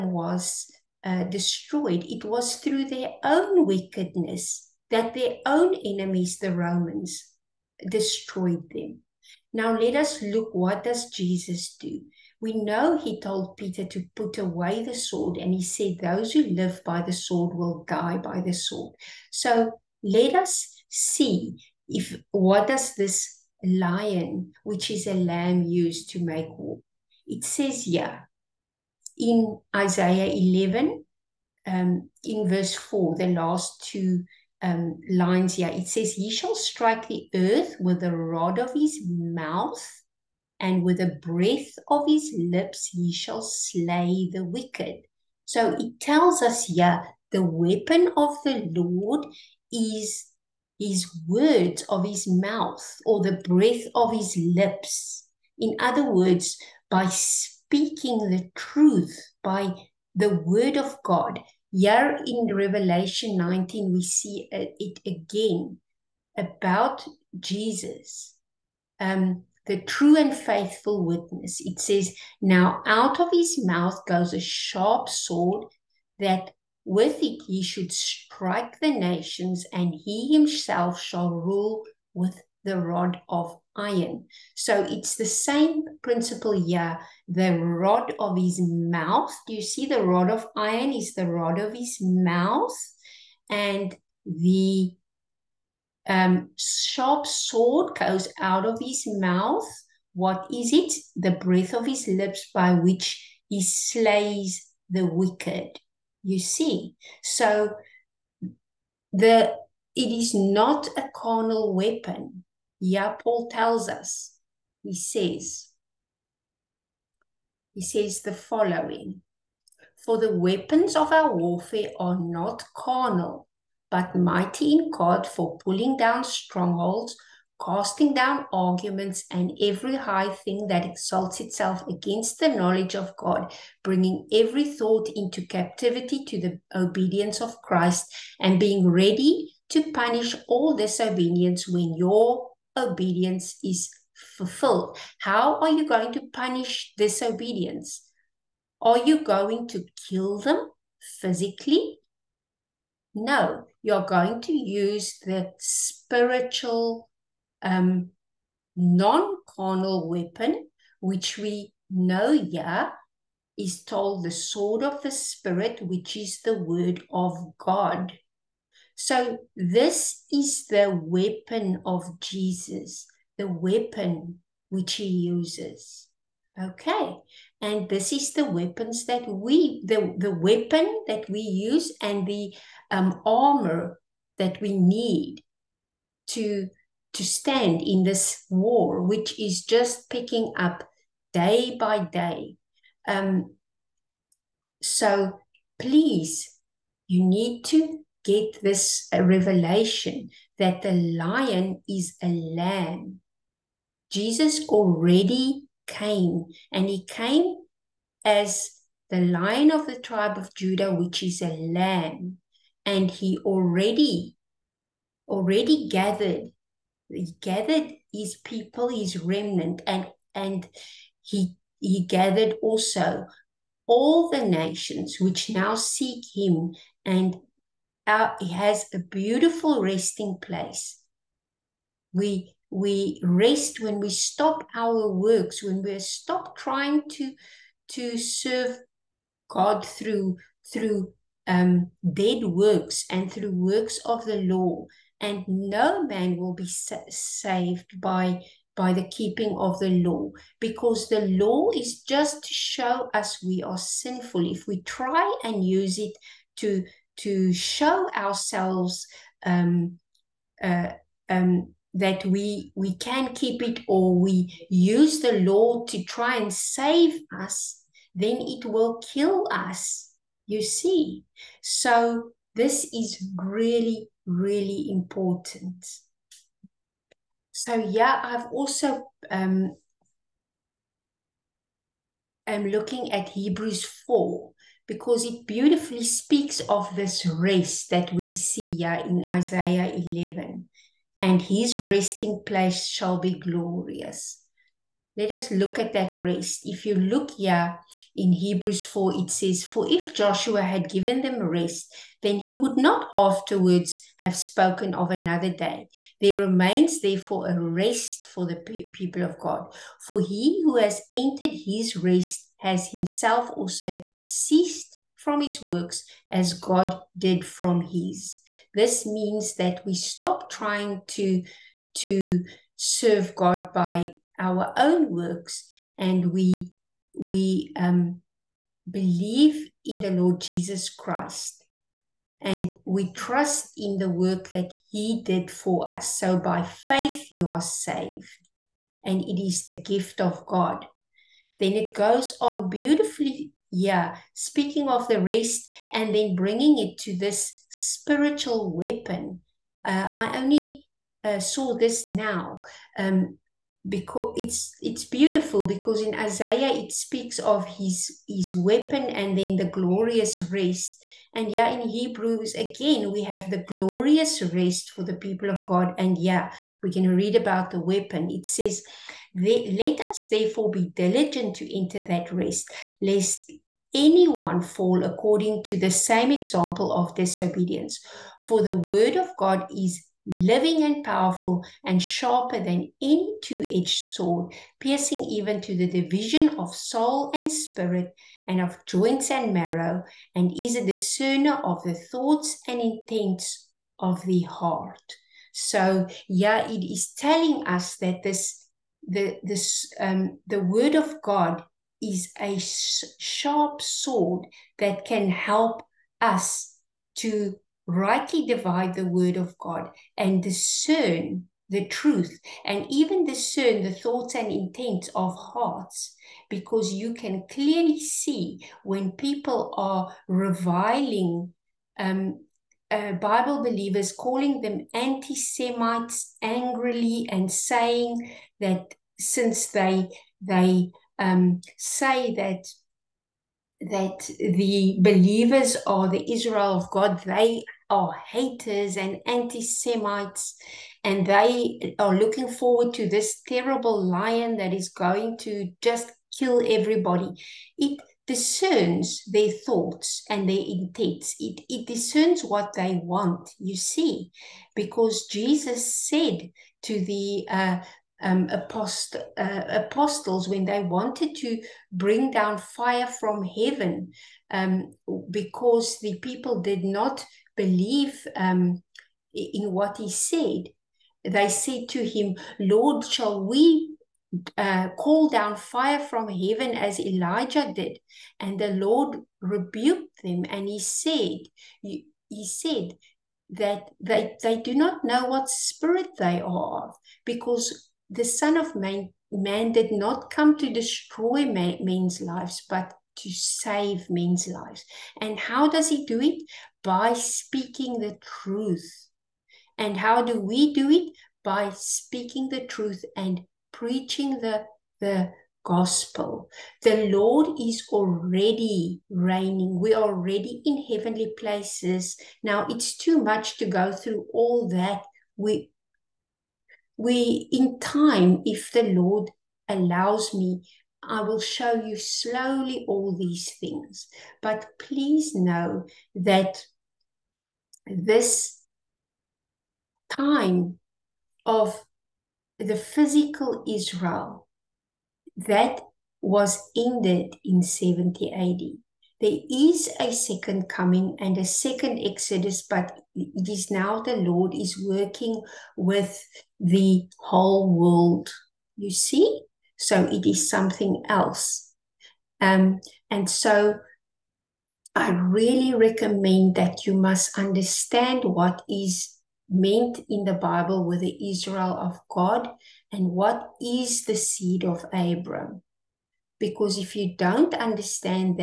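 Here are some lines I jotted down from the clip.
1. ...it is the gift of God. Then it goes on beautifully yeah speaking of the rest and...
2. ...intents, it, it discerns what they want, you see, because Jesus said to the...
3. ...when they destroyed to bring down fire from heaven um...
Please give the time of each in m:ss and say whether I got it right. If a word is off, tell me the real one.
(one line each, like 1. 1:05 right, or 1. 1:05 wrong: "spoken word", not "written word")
1. 5:39 right
2. 7:30 right
3. 7:40 wrong: "wanted", not "destroyed".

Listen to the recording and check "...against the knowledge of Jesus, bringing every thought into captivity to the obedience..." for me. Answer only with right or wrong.
wrong.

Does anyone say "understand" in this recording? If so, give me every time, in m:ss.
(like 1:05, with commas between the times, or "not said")
9:17, 9:27.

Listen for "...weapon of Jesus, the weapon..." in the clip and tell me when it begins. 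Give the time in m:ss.
2:51.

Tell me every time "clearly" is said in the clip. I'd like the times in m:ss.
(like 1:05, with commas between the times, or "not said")
6:57.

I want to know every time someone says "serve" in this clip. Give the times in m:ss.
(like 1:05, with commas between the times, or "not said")
3:58, 5:22.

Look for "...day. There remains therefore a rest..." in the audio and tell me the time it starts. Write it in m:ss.
5:05.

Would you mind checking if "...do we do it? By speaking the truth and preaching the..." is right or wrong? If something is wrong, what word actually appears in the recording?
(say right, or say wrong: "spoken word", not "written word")
right.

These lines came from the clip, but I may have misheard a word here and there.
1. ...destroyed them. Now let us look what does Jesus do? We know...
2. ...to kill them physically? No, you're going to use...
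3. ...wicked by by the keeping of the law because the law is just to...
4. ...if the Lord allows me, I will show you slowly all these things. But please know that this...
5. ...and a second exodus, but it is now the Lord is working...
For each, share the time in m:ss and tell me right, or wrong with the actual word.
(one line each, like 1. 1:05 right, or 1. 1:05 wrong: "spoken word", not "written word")
1. 0:07 right
2. 2:29 right
3. 4:06 wrong: "saved", not "wicked"
4. 8:38 right
5. 9:01 right.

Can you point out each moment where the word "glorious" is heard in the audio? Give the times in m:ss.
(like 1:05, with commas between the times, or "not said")
4:53, 5:59, 6:03.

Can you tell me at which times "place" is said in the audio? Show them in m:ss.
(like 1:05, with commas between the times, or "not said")
3:50, 4:52, 8:31.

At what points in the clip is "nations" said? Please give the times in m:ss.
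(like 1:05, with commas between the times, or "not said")
1:18, 3:44.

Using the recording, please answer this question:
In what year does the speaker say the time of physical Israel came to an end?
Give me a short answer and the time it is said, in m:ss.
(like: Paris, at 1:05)
70 AD, at 8:57.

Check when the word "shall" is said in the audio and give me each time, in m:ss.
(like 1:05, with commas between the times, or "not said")
0:36, 0:43, 1:20, 4:52, 7:53.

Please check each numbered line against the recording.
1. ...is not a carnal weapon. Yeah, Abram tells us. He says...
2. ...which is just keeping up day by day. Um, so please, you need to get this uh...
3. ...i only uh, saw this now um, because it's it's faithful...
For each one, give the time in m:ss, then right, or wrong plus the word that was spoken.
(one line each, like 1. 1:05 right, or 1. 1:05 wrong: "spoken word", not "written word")
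1. 1:50 wrong: "Paul", not "Abram"
2. 3:09 wrong: "picking", not "keeping"
3. 5:50 wrong: "beautiful", not "faithful".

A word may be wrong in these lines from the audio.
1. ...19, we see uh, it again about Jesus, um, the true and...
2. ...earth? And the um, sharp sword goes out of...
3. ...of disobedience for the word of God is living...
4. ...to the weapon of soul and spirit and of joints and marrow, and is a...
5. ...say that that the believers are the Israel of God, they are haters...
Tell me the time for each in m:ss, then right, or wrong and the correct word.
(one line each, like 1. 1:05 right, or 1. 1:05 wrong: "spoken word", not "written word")
1. 1:03 right
2. 1:32 wrong: "mouth", not "earth"
3. 6:16 right
4. 6:25 wrong: "division", not "weapon"
5. 7:11 right.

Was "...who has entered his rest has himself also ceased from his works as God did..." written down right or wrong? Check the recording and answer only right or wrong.
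right.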